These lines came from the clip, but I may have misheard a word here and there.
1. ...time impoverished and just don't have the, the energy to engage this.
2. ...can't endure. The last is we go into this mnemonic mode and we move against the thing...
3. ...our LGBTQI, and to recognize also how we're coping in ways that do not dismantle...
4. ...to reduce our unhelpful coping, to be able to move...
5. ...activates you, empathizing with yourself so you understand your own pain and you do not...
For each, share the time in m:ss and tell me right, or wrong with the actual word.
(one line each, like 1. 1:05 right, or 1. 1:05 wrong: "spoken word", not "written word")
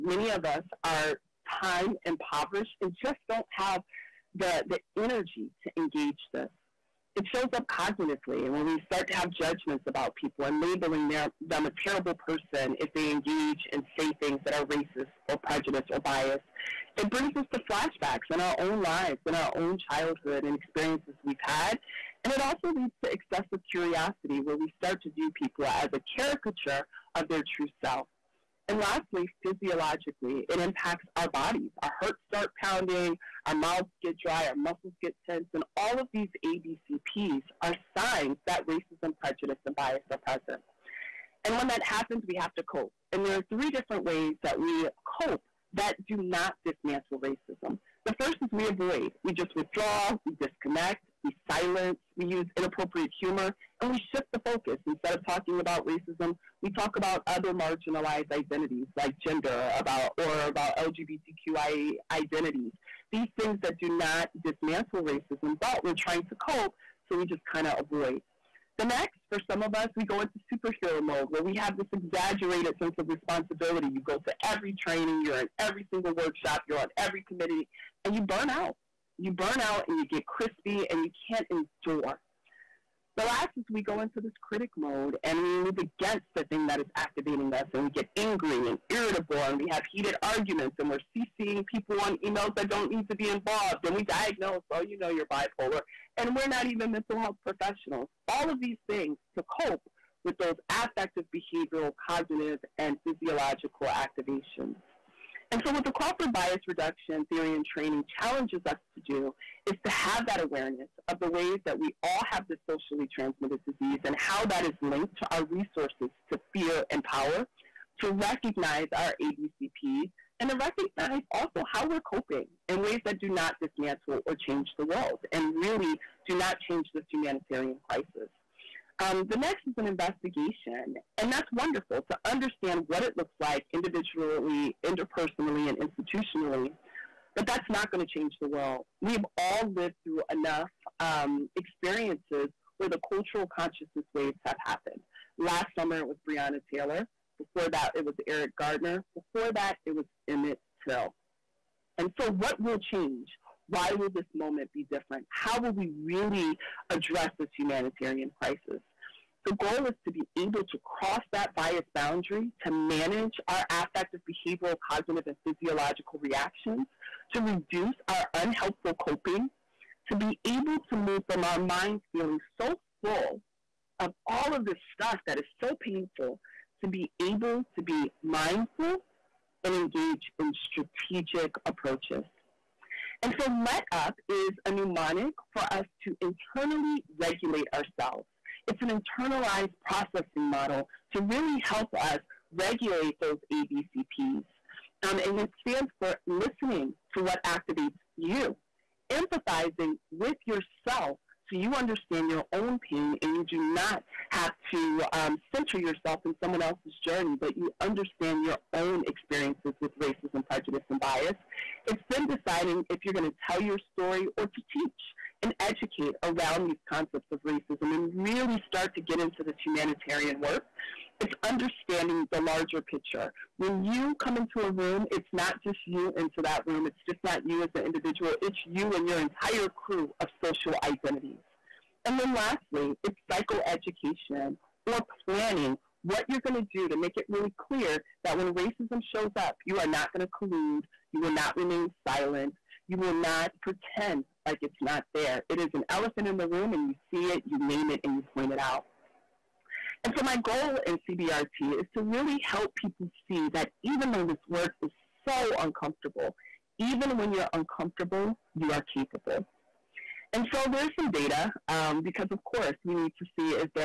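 1. 0:01 right
2. 1:21 wrong: "critic", not "mnemonic"
3. 1:58 wrong: "ABCPs", not "LGBTQI"
4. 2:47 right
5. 3:17 right.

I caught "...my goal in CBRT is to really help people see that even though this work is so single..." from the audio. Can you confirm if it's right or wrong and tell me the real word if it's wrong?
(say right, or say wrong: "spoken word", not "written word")
wrong: "uncomfortable", not "single".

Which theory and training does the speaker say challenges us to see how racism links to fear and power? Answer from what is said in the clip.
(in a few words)
Crawford bias reduction theory.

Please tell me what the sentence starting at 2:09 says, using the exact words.
Um, the next is an investigation, and that's wonderful to understand what it looks like individually, interpersonally, and institutionally.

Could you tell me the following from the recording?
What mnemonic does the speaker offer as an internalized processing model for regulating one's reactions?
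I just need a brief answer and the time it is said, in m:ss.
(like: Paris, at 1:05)
LET UP, at 3:03.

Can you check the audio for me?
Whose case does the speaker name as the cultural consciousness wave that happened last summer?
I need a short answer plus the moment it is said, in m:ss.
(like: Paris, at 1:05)
Breonna Taylor, at 2:26.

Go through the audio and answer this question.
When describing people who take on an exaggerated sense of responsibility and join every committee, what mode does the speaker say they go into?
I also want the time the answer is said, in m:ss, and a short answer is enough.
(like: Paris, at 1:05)
superhero mode, at 1:10.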